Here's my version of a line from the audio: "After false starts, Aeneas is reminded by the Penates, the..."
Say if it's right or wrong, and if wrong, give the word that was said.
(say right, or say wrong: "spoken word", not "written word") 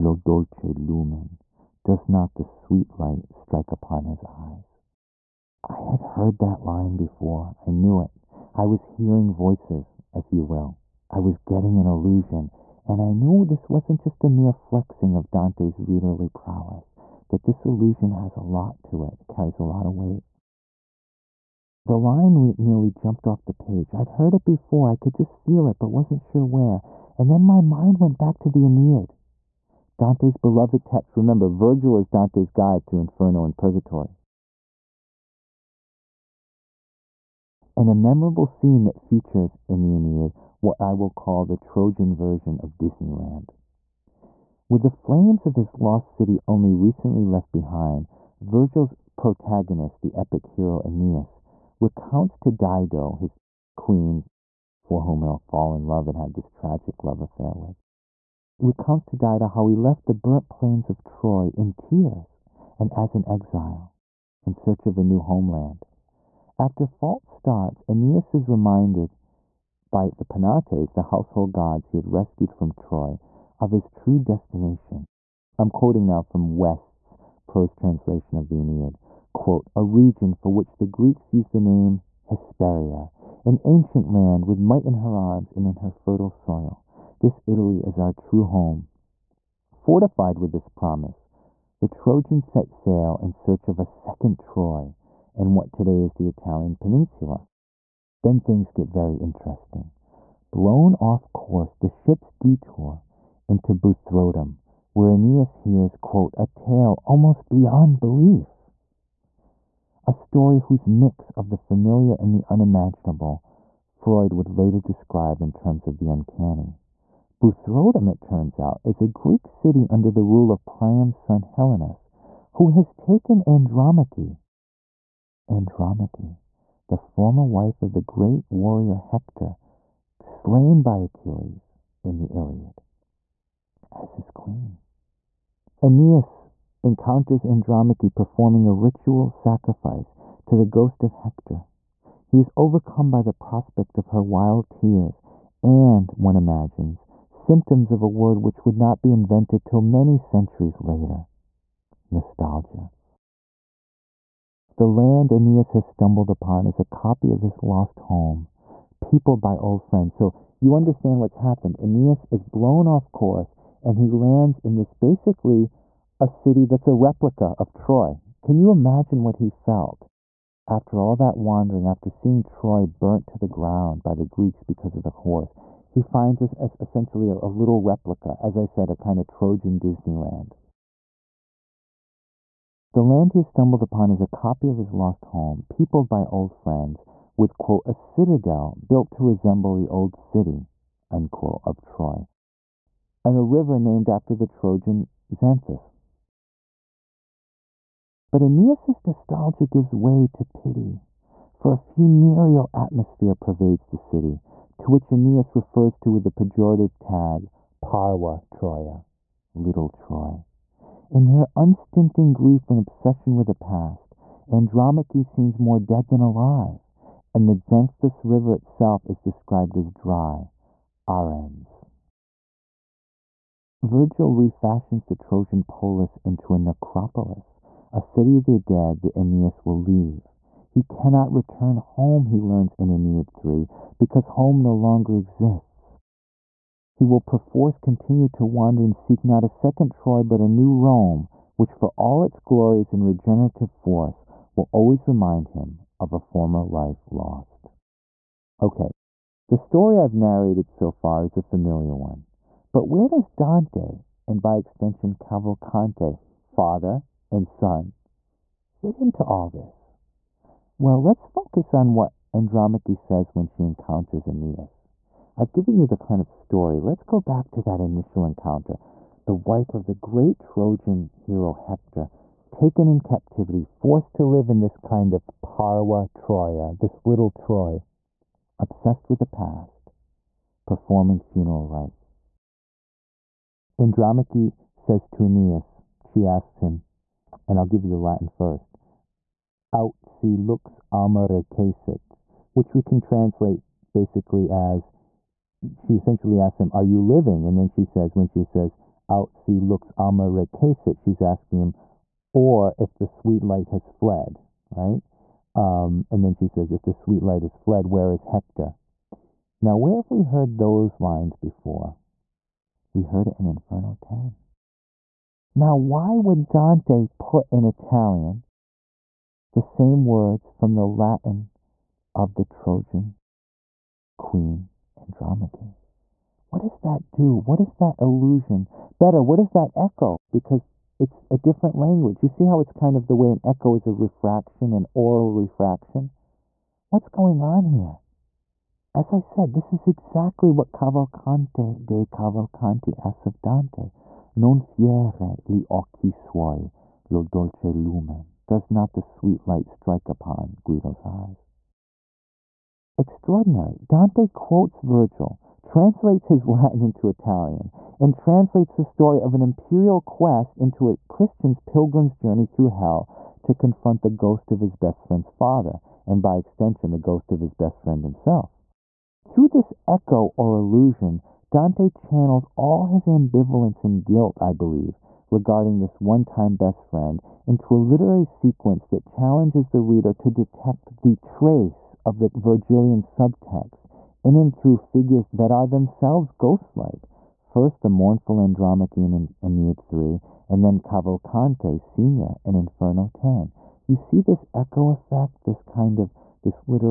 right.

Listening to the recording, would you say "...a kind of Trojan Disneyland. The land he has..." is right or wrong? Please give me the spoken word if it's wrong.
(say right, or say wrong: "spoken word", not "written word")
right.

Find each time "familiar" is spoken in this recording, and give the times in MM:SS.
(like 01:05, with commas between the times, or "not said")
01:51, 04:11.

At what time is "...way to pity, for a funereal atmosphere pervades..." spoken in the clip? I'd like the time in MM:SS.
03:19.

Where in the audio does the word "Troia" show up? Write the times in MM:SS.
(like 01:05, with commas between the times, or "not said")
03:28, 04:36.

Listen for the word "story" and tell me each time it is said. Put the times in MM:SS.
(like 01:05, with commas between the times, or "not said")
01:50, 04:09, 04:26, 05:58.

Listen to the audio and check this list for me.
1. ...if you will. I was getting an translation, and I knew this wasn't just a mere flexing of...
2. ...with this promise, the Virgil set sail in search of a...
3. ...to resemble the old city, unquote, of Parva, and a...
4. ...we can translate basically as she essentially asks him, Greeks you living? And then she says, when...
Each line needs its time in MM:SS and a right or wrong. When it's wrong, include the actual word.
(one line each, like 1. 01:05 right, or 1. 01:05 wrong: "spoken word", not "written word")
1. 00:10 wrong: "allusion", not "translation"
2. 01:30 wrong: "Trojans", not "Virgil"
3. 03:09 wrong: "Troy", not "Parva"
4. 04:52 wrong: "Are", not "Greeks".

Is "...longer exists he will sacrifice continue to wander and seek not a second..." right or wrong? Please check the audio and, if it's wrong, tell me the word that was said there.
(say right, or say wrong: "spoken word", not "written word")
wrong: "perforce", not "sacrifice".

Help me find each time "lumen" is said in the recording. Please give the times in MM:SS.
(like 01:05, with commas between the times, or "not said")
00:00, 05:47.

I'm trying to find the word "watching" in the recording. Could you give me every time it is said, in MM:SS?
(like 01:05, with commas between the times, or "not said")
not said.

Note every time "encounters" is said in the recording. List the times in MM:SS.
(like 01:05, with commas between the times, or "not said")
02:16, 04:23, 04:28.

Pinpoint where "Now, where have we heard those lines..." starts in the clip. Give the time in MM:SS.
05:09.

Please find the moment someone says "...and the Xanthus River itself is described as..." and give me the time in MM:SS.
03:37.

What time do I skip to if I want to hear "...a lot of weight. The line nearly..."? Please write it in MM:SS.
00:19.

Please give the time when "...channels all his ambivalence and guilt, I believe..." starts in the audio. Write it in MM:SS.
06:11.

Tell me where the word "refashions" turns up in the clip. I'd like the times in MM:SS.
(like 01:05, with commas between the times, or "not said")
03:44.